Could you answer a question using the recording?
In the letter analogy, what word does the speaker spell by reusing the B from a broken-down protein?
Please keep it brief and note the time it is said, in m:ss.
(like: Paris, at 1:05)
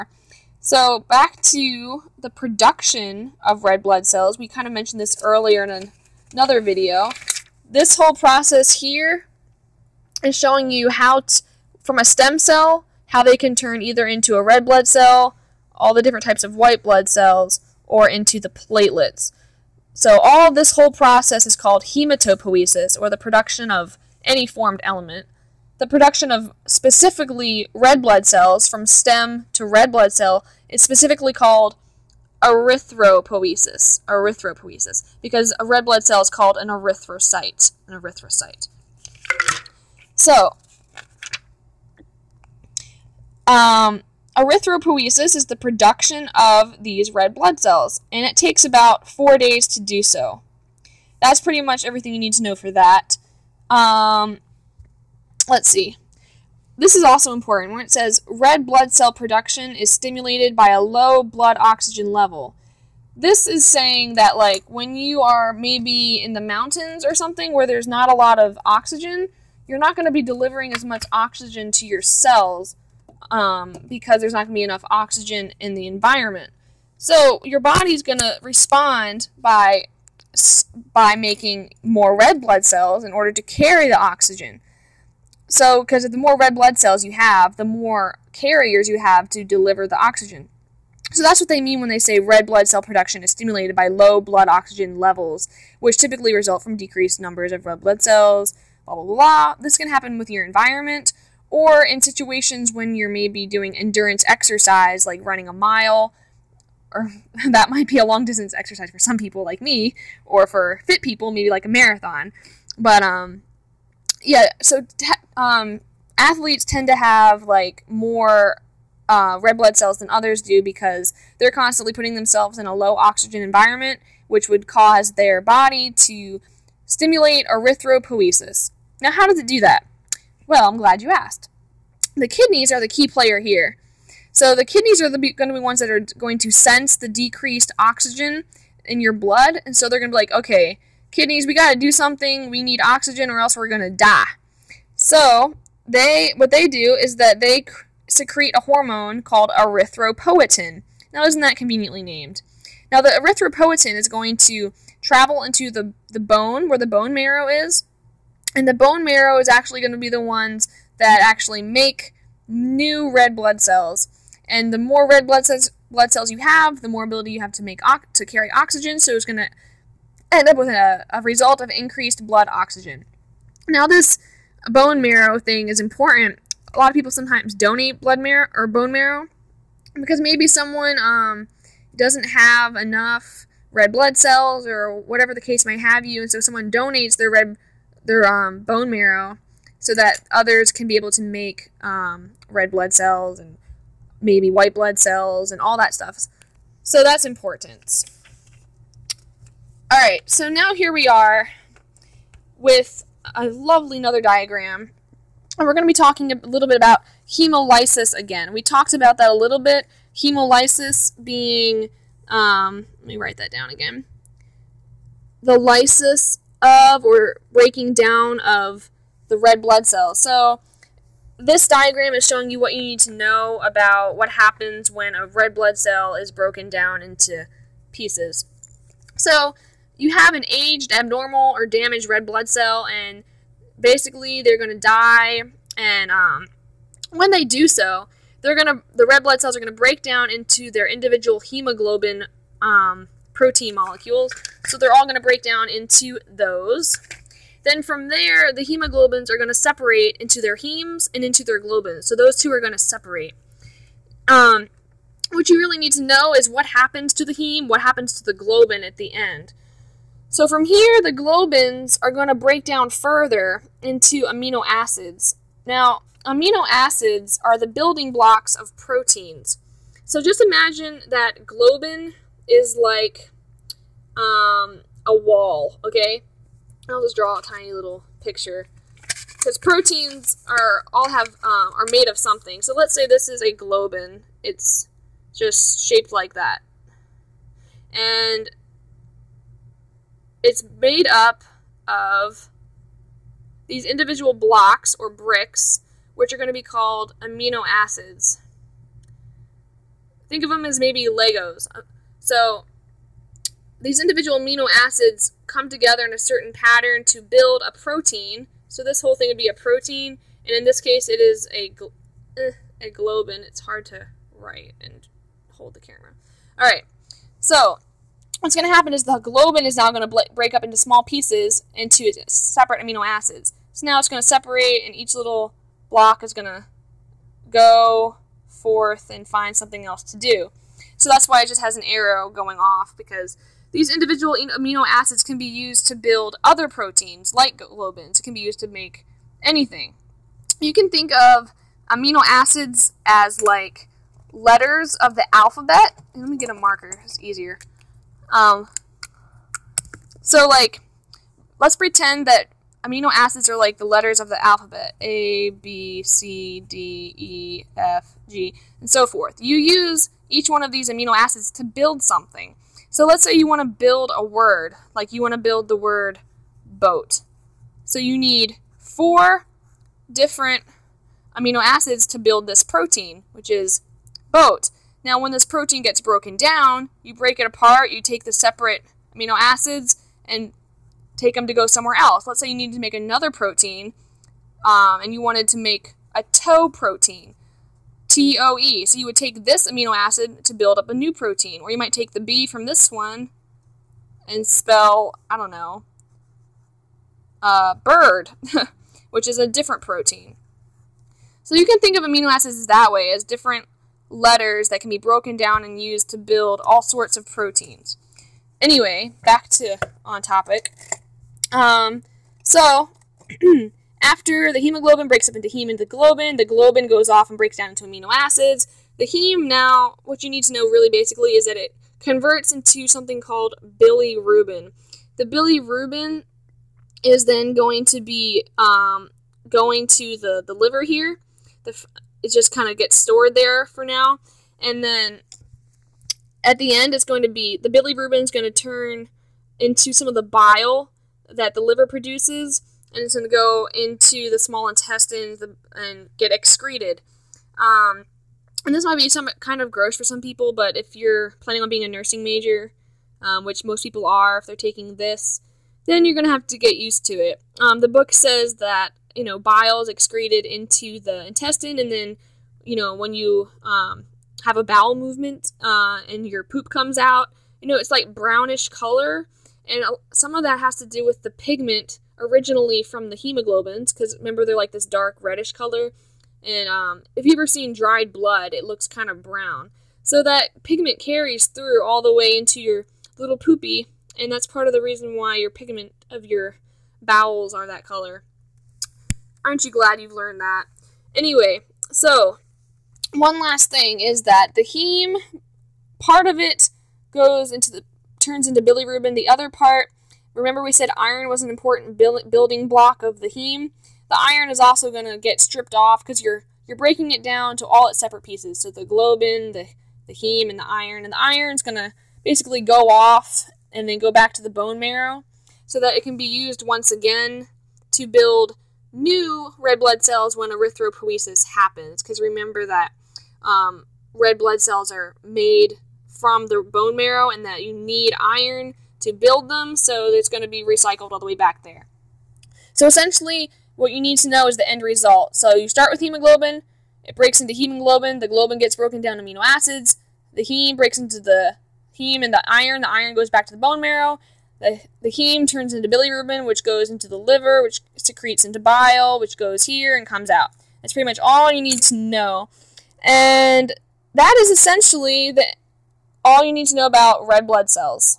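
Bird, at 6:37.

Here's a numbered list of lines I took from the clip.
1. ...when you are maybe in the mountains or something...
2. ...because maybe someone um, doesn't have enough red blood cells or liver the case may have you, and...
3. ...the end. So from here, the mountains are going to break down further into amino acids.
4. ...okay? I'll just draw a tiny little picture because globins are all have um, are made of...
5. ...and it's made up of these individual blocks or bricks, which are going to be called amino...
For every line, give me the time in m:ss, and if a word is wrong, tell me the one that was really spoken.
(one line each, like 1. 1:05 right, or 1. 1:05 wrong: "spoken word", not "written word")
1. 1:04 right
2. 2:59 wrong: "whatever", not "liver"
3. 4:18 wrong: "globins", not "mountains"
4. 4:35 wrong: "proteins", not "globins"
5. 4:47 right.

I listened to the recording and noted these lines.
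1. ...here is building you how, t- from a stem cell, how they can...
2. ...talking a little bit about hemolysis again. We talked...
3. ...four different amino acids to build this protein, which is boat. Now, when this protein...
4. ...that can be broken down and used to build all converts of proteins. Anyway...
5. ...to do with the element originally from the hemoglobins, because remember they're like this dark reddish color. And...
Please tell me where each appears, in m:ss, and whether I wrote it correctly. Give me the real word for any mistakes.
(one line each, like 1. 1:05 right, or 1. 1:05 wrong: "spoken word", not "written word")
1. 0:08 wrong: "showing", not "building"
2. 3:25 right
3. 6:08 right
4. 6:44 wrong: "sorts", not "converts"
5. 7:50 wrong: "pigment", not "element".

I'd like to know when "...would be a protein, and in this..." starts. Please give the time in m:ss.
5:09.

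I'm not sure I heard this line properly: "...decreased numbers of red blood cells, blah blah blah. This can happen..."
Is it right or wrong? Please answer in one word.
right.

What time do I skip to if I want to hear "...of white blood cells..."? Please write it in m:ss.
0:16.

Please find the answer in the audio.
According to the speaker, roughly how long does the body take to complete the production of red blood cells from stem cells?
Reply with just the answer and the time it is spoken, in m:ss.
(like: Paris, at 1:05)
4 days, at 0:49.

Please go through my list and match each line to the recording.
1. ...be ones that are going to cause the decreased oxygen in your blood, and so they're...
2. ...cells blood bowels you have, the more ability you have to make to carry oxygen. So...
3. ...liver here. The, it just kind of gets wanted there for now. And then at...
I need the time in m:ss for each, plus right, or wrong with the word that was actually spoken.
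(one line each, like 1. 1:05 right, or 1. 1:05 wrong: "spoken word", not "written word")
1. 2:15 wrong: "sense", not "cause"
2. 2:45 wrong: "cells", not "bowels"
3. 7:10 wrong: "stored", not "wanted".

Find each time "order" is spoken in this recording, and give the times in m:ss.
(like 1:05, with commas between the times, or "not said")
1:23.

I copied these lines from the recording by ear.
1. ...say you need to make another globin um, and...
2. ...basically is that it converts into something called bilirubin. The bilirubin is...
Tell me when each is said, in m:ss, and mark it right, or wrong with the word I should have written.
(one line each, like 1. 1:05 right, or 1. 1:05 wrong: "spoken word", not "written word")
1. 6:22 wrong: "protein", not "globin"
2. 7:00 right.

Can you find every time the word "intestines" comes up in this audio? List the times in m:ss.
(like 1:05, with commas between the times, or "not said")
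7:24, 7:41.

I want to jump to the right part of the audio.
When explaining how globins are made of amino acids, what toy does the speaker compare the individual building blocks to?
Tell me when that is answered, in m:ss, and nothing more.
5:01.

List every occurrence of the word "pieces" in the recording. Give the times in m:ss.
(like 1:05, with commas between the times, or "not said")
3:47, 5:21, 8:28.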